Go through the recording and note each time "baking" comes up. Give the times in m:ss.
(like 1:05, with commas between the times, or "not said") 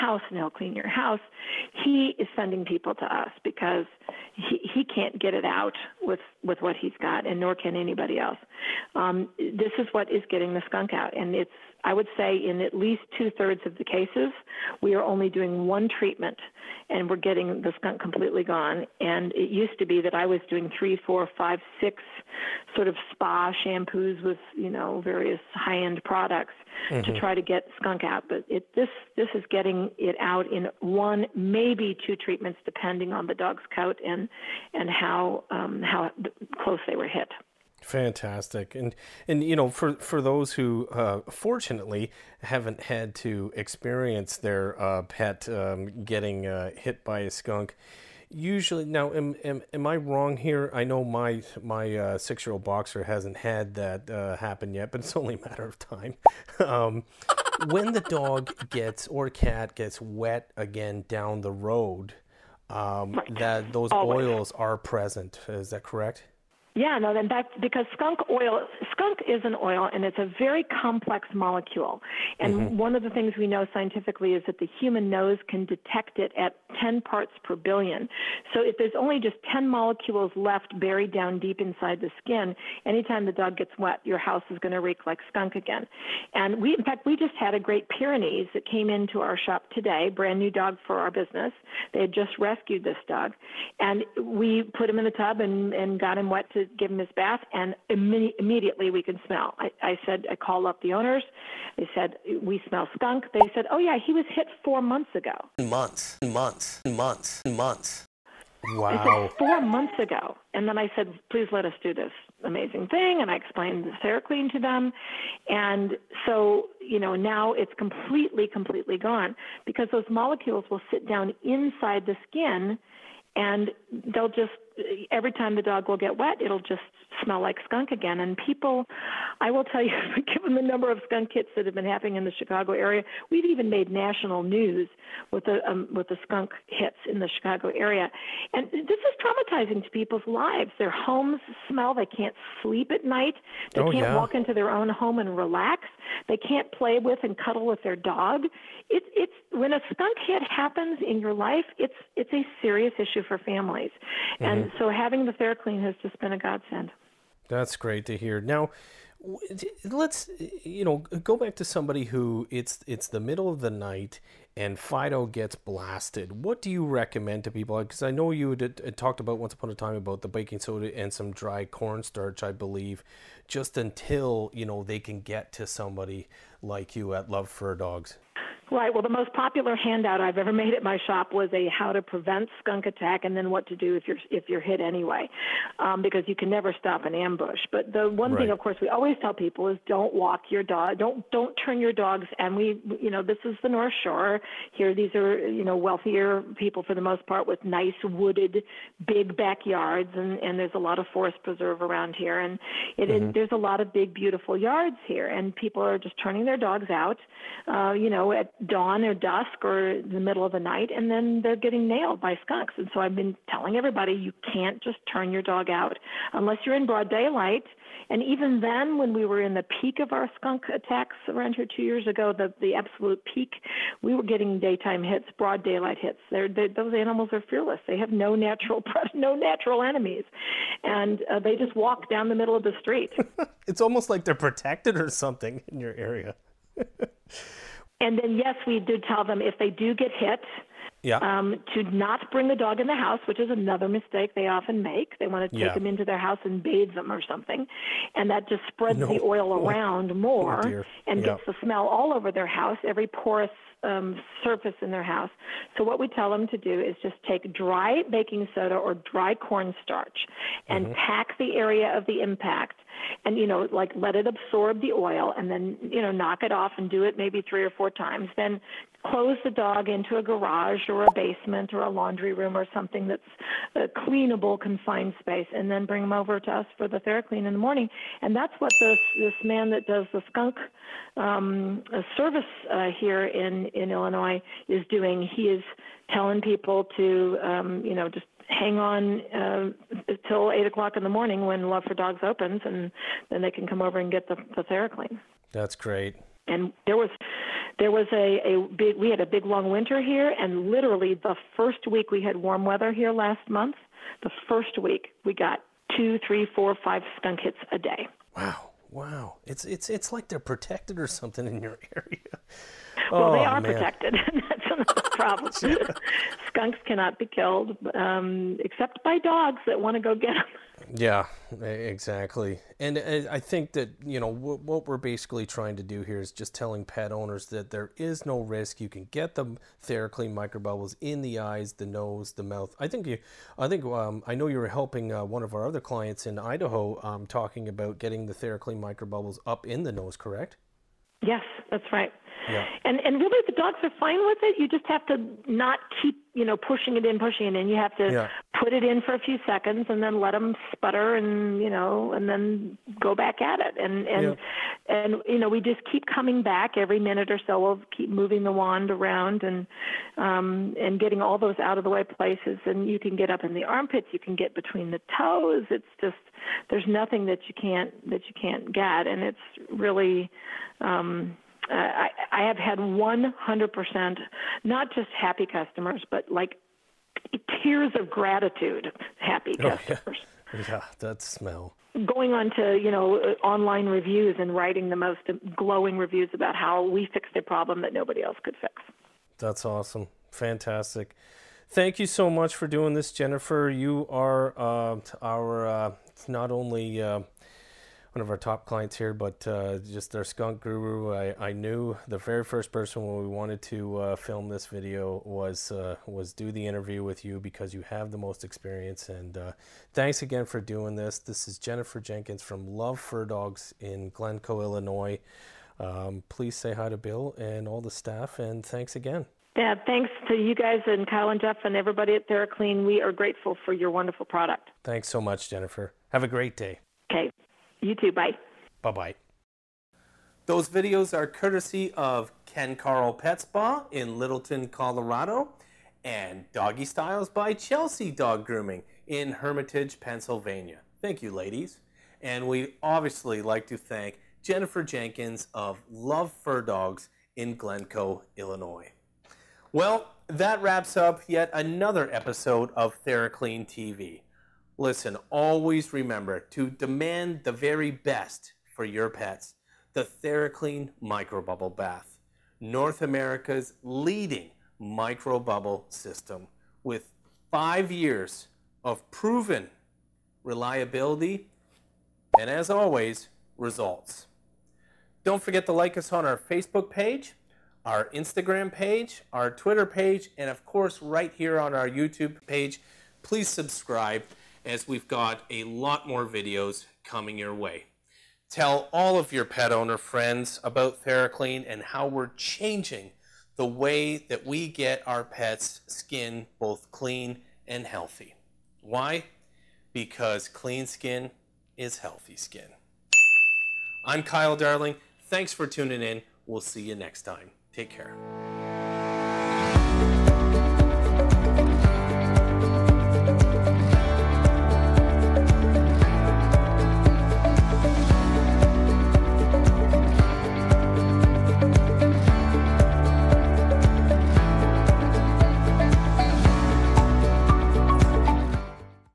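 2:50, 4:18.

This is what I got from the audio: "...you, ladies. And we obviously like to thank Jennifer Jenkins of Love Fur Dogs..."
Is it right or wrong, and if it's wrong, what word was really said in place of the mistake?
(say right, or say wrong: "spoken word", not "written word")
right.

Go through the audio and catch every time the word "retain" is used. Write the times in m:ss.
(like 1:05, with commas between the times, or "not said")
not said.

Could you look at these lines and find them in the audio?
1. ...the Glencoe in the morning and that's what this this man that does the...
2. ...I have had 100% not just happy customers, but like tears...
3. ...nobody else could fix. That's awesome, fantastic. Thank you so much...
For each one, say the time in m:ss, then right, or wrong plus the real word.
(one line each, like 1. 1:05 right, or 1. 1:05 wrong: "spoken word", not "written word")
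1. 4:36 wrong: "TheraClean", not "Glencoe"
2. 6:12 right
3. 6:27 right.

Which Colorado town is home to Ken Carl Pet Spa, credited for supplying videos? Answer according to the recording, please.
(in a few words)
Littleton.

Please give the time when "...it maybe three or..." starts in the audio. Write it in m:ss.
4:27.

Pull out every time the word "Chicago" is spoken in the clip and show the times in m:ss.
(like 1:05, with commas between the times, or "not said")
2:12, 2:17.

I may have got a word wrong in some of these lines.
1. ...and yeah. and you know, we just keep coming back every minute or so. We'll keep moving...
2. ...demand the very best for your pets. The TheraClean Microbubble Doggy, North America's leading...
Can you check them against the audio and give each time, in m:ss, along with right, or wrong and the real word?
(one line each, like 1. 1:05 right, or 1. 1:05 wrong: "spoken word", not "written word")
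1. 5:54 right
2. 7:36 wrong: "Bath", not "Doggy".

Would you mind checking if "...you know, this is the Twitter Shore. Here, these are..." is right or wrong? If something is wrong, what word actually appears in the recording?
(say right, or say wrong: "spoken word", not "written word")
wrong: "North", not "Twitter".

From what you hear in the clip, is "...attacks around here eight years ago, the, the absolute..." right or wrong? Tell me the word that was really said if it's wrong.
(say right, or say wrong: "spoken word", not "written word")
wrong: "two", not "eight".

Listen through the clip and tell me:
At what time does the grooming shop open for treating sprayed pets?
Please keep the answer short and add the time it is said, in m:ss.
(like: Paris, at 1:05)
8 o'clock, at 4:50.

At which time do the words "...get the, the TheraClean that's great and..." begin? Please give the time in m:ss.
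4:54.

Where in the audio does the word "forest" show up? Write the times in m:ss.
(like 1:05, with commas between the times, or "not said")
3:21.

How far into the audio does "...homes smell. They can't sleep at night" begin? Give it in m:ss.
2:20.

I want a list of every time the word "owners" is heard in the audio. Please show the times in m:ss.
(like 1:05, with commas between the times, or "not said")
1:40, 5:27, 8:09.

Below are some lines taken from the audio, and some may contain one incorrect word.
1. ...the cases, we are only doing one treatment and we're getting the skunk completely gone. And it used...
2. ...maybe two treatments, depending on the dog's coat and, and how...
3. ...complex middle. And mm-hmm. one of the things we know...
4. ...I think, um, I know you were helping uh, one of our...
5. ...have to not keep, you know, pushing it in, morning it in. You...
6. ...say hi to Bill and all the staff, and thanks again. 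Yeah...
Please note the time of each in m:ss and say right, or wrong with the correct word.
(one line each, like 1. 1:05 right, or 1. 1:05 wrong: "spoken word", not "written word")
1. 0:13 right
2. 0:31 right
3. 1:10 wrong: "molecule", not "middle"
4. 5:33 right
5. 5:44 wrong: "pushing", not "morning"
6. 6:56 right.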